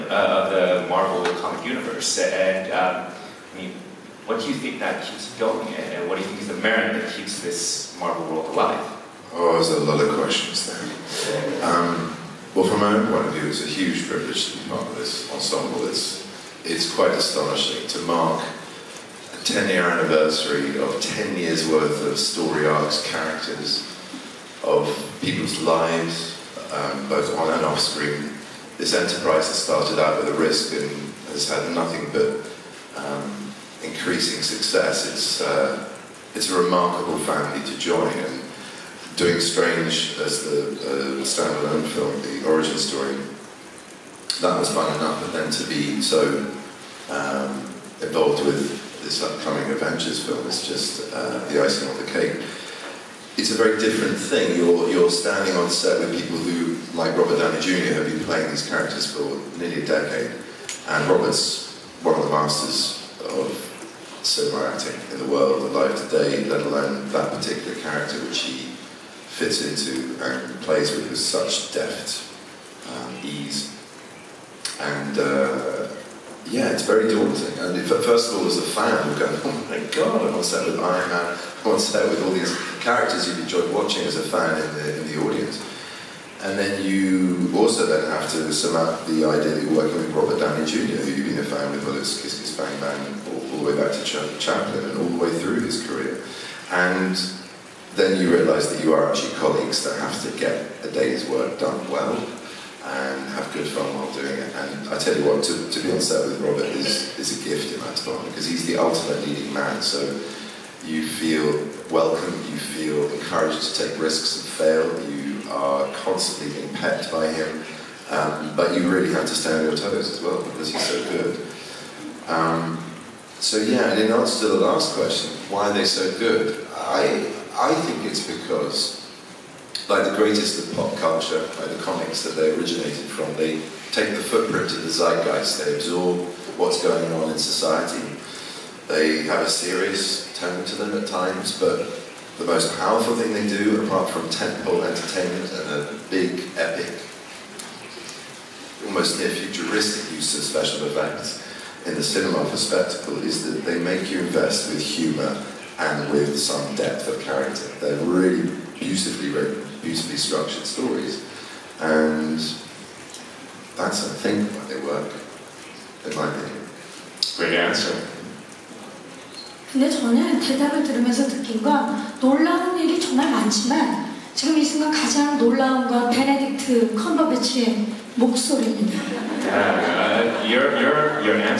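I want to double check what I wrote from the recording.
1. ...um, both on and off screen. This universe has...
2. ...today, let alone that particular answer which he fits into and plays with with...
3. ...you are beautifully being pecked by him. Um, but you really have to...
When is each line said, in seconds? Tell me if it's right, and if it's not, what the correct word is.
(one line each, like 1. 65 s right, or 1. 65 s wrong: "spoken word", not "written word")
1. 26 s wrong: "enterprise", not "universe"
2. 66 s wrong: "character", not "answer"
3. 115 s wrong: "constantly", not "beautifully".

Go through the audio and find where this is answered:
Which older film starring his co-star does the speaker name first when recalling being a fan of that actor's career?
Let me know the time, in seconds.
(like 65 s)
92 s.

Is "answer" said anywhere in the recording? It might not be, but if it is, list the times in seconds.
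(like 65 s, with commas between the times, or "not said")
124 s, 167 s.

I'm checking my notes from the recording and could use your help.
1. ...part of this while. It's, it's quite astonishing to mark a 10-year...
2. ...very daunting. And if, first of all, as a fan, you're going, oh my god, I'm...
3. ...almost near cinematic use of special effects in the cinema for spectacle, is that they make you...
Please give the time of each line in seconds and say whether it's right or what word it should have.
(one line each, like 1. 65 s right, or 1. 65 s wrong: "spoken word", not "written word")
1. 14 s wrong: "ensemble", not "while"
2. 76 s right
3. 148 s wrong: "futuristic", not "cinematic".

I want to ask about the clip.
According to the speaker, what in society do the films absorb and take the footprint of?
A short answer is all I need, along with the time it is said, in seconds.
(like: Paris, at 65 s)
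the zeitgeist, at 134 s.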